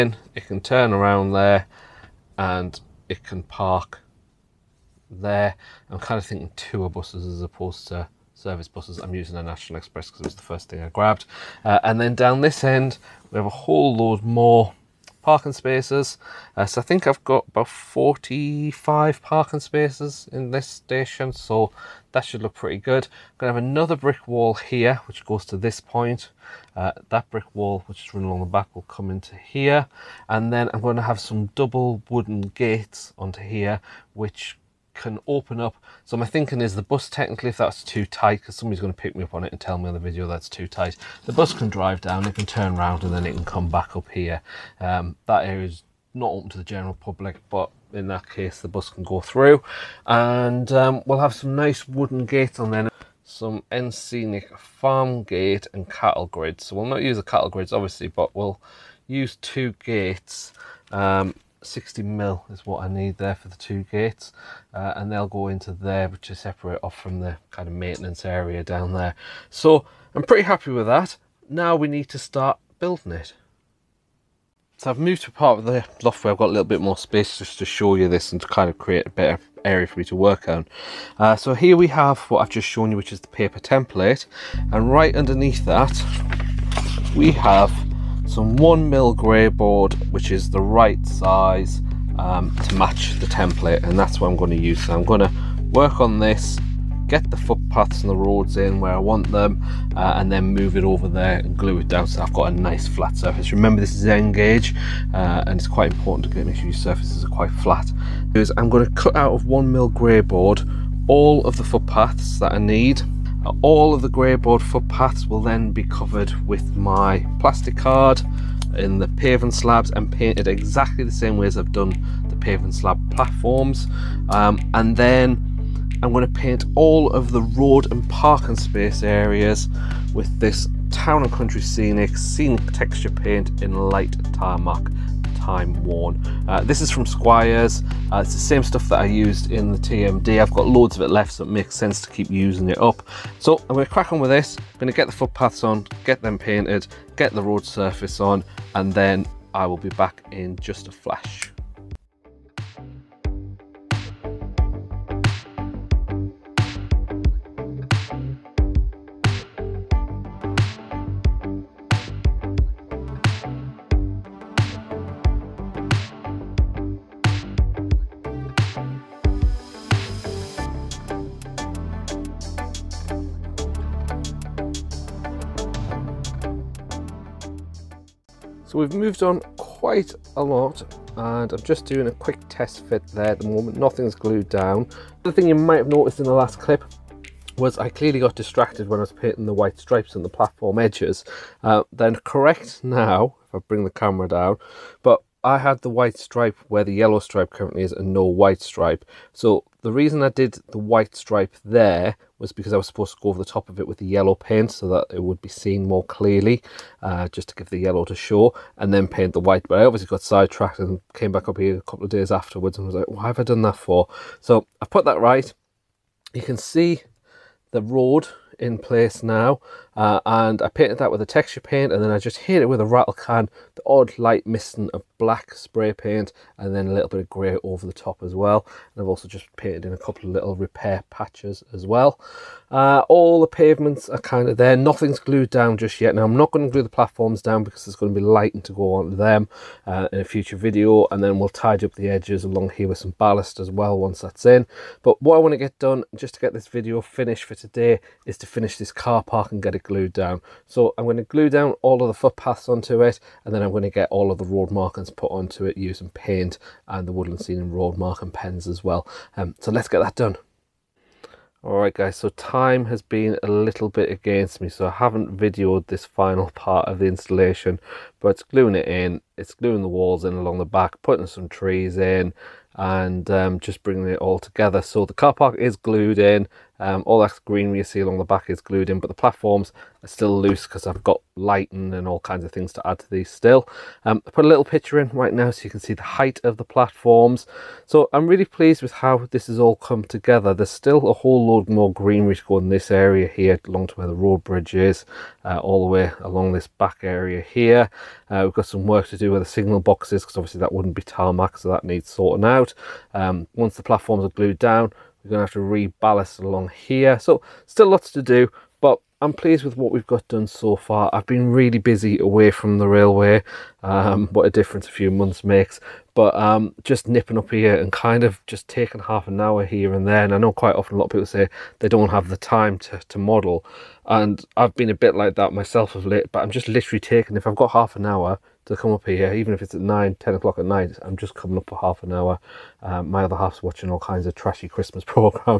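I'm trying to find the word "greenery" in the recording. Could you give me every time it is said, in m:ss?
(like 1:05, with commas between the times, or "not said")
4:37, 4:51.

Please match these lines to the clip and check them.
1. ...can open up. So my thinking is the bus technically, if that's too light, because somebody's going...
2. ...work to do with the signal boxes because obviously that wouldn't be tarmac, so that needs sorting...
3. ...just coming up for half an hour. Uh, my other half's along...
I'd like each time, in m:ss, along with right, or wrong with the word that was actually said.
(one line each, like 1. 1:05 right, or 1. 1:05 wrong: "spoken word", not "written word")
1. 0:34 wrong: "tight", not "light"
2. 4:58 right
3. 5:31 wrong: "watching", not "along".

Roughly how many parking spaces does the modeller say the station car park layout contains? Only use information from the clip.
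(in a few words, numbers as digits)
45.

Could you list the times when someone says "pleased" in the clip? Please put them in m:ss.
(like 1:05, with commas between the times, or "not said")
4:48, 5:09.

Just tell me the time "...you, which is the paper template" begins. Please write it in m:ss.
1:22.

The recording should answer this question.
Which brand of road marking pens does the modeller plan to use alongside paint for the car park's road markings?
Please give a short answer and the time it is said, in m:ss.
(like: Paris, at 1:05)
Woodland Scenics, at 4:17.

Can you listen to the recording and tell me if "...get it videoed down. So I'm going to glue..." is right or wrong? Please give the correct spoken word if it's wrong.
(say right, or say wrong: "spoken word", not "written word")
wrong: "glued", not "videoed".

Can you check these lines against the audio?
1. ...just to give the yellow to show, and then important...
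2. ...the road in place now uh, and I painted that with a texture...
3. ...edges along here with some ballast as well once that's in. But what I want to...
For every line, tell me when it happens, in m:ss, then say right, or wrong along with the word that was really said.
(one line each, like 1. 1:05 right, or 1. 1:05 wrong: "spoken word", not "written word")
1. 3:27 wrong: "paint", not "important"
2. 3:37 right
3. 4:02 right.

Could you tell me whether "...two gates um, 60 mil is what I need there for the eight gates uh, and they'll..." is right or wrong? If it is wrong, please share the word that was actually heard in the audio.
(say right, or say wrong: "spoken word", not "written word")
wrong: "two", not "eight".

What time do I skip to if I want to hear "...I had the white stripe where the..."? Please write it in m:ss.
3:15.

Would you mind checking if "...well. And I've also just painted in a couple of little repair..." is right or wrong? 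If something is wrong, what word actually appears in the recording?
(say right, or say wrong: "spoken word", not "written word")
right.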